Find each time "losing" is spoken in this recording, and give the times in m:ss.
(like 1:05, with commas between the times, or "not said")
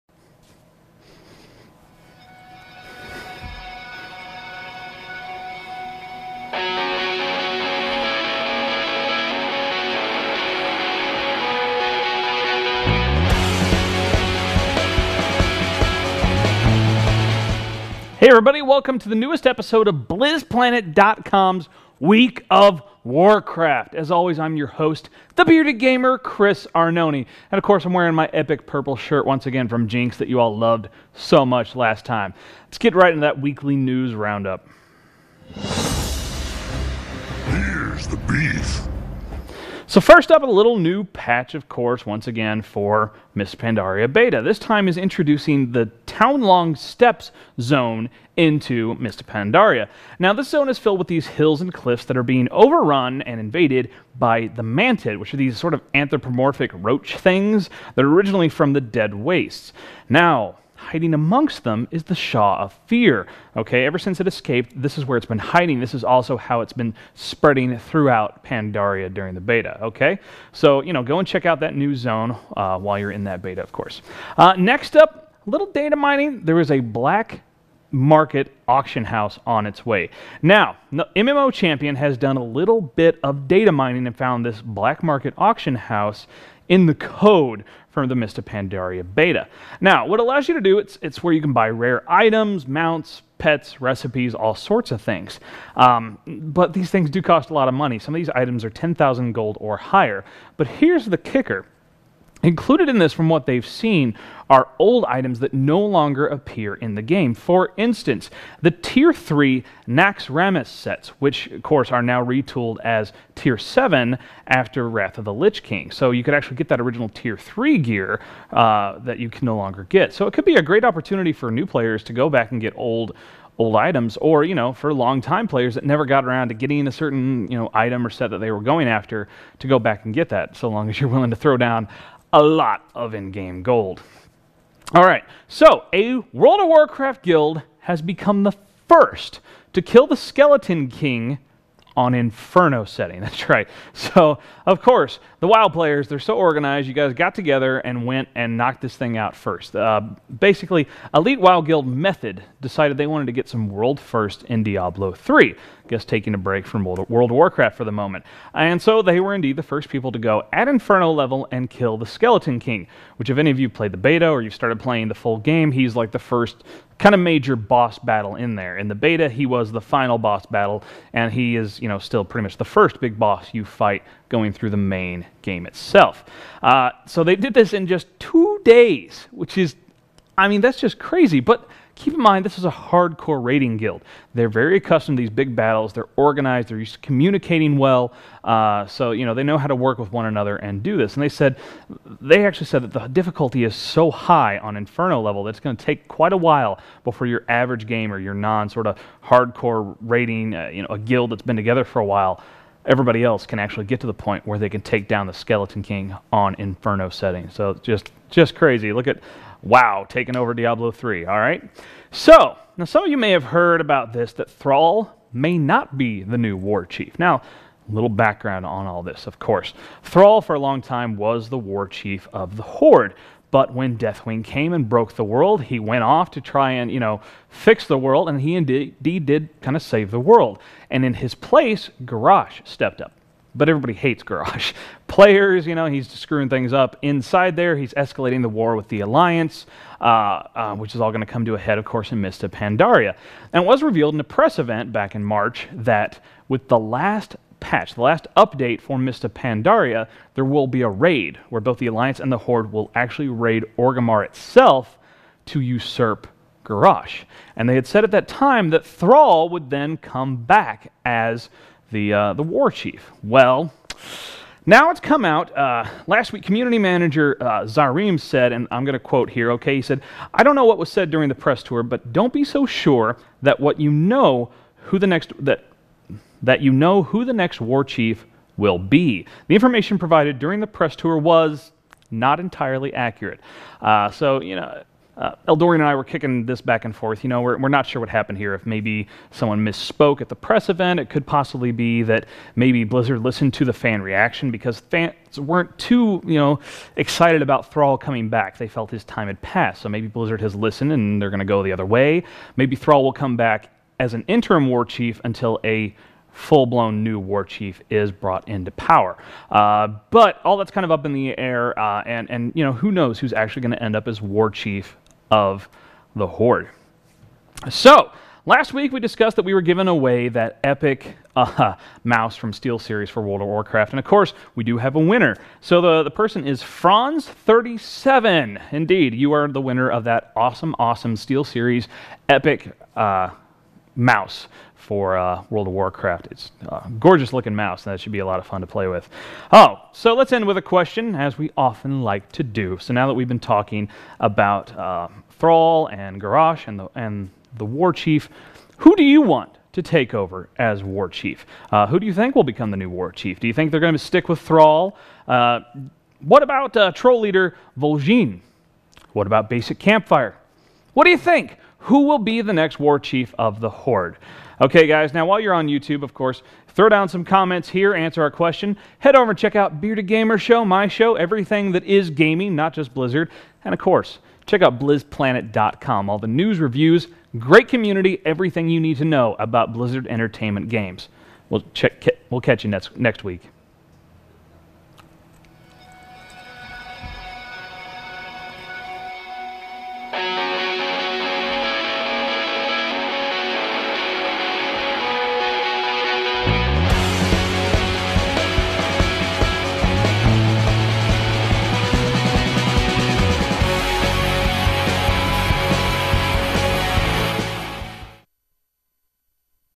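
not said.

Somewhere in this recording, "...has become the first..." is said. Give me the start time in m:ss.
2:17.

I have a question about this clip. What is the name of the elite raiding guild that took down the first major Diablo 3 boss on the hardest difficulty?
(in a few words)
Method.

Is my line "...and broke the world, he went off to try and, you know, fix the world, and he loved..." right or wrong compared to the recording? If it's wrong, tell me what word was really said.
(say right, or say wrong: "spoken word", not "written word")
wrong: "indeed", not "loved".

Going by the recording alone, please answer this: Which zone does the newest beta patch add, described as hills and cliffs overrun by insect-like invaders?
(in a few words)
Townlong Steppes.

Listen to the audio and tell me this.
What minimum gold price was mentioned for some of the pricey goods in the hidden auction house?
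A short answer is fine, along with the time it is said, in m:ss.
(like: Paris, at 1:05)
10,000 gold, at 1:38.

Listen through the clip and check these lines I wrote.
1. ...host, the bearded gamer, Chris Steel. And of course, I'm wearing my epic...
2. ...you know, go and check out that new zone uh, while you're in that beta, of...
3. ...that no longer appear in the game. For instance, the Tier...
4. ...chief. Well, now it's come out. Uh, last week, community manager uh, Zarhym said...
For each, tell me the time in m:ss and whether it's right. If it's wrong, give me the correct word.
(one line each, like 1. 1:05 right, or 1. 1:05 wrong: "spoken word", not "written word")
1. 0:24 wrong: "Arnone", not "Steel"
2. 1:10 right
3. 1:45 right
4. 4:22 right.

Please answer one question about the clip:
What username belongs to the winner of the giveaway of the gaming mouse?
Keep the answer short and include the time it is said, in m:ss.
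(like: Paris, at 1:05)
Franzz37, at 5:26.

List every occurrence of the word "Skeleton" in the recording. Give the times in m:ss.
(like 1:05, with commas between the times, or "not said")
2:20, 2:42, 3:25.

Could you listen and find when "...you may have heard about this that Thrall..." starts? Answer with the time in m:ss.
3:33.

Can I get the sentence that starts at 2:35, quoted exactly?
Guess taking a break from World, World of Warcraft for the moment.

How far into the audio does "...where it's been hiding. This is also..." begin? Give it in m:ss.
1:05.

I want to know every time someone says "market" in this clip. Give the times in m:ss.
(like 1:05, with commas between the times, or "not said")
1:17, 1:25.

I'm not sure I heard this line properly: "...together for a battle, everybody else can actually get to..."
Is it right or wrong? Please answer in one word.
wrong.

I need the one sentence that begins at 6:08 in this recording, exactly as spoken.
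Head over and check out Bearded Gamer Show, my show, everything that is gaming, not just Blizzard.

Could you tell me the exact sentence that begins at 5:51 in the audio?
Uh, who do you think will become the new War Chief?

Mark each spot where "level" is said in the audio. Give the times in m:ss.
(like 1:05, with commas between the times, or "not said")
2:41, 3:15.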